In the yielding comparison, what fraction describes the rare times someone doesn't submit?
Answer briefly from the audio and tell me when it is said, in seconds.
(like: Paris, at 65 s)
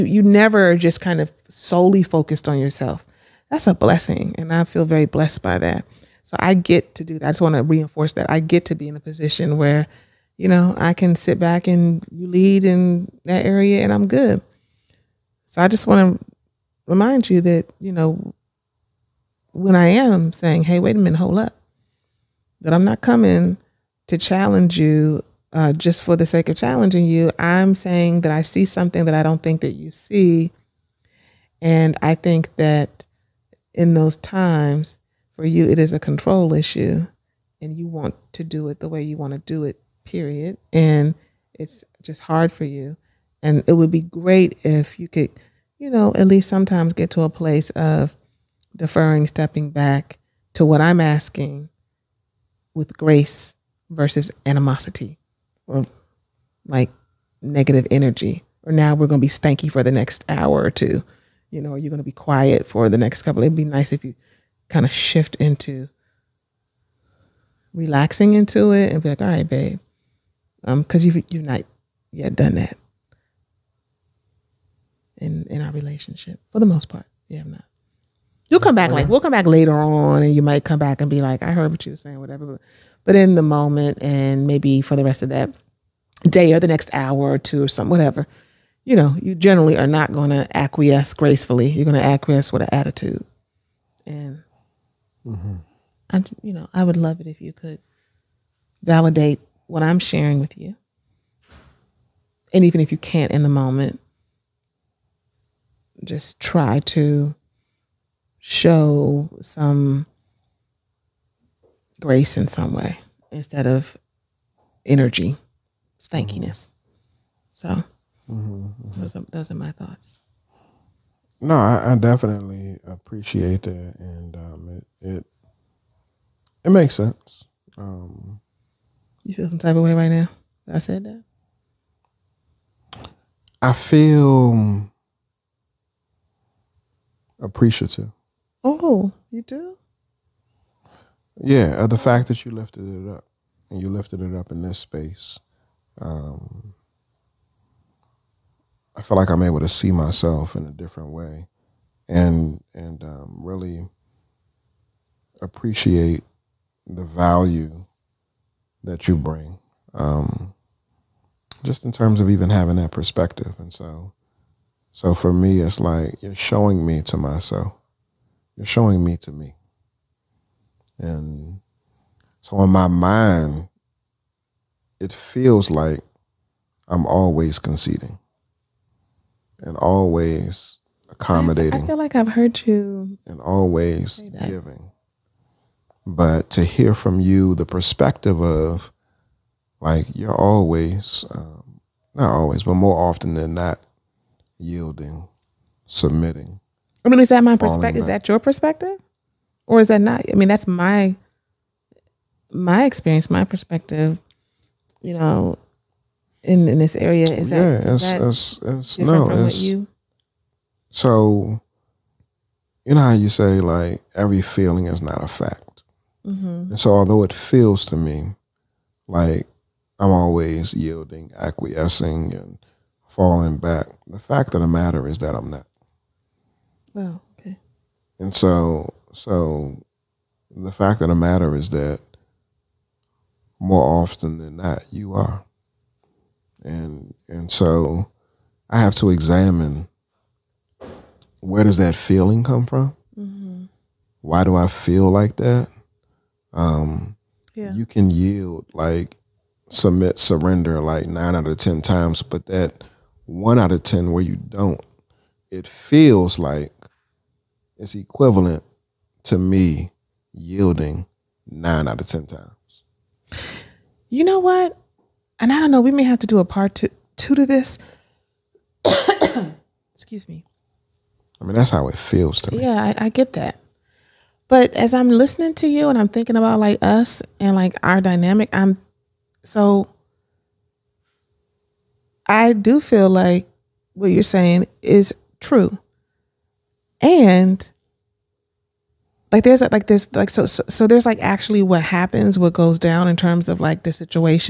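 1 out of 10, at 253 s.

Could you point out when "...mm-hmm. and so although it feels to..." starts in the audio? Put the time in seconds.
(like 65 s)
216 s.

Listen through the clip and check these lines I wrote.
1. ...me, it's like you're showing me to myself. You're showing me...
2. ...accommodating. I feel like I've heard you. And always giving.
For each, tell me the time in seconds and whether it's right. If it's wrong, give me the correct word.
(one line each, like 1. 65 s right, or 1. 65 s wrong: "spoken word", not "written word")
1. 165 s right
2. 181 s right.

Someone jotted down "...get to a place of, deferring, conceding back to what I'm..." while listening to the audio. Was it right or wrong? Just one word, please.
wrong.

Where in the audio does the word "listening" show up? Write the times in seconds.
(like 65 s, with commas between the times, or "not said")
275 s.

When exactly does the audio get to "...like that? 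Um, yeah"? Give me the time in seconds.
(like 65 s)
245 s.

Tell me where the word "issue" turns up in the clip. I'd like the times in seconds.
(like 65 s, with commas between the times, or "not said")
36 s.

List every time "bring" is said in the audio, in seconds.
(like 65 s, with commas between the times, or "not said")
159 s.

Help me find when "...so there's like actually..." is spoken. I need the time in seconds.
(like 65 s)
290 s.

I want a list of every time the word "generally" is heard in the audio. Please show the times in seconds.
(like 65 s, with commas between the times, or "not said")
89 s.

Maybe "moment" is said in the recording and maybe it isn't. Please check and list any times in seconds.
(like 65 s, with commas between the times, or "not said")
83 s, 103 s.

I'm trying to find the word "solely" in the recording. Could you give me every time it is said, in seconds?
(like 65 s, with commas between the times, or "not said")
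1 s.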